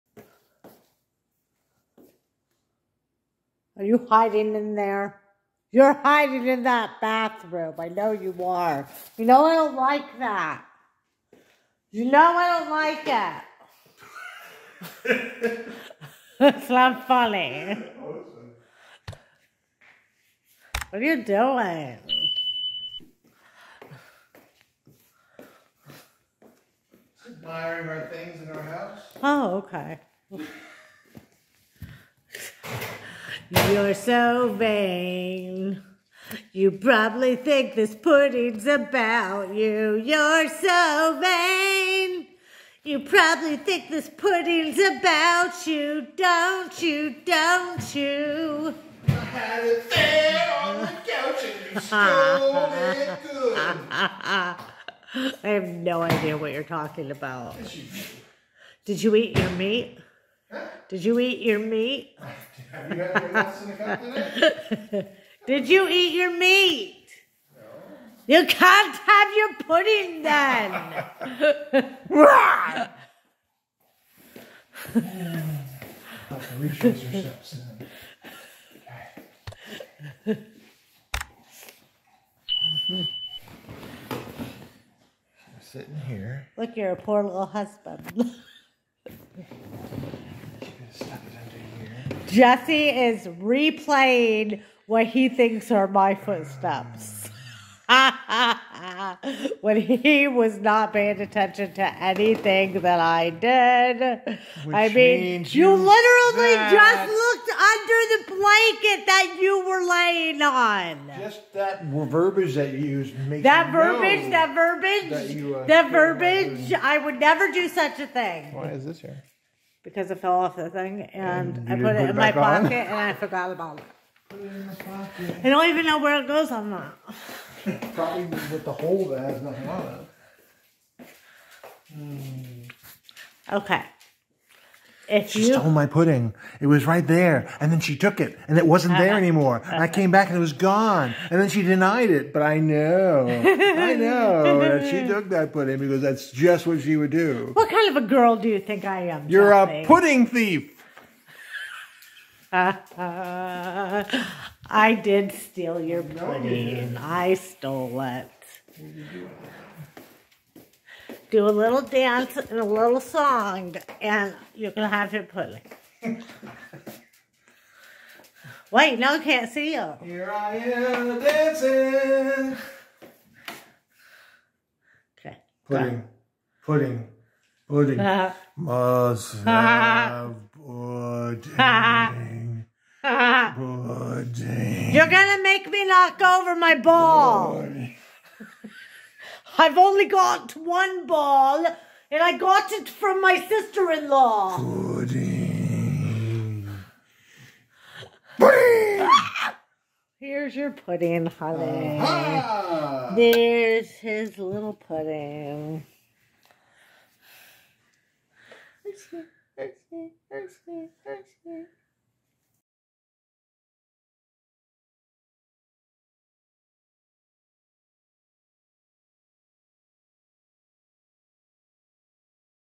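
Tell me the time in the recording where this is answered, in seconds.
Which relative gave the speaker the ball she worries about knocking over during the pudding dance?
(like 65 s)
193 s.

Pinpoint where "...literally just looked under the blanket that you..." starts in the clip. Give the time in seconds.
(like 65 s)
105 s.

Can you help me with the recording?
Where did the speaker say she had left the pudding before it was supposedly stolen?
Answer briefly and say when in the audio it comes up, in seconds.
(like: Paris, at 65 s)
on the couch, at 50 s.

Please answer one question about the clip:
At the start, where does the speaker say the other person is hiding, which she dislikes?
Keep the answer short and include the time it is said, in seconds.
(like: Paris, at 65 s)
bathroom, at 7 s.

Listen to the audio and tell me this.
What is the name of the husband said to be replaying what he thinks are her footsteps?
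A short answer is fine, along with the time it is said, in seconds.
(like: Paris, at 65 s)
Jesse, at 92 s.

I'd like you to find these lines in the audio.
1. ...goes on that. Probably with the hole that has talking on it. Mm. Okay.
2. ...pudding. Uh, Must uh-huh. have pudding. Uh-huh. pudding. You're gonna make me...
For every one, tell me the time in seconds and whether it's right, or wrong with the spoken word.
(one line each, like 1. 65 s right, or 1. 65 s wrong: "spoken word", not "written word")
1. 126 s wrong: "nothing", not "talking"
2. 177 s right.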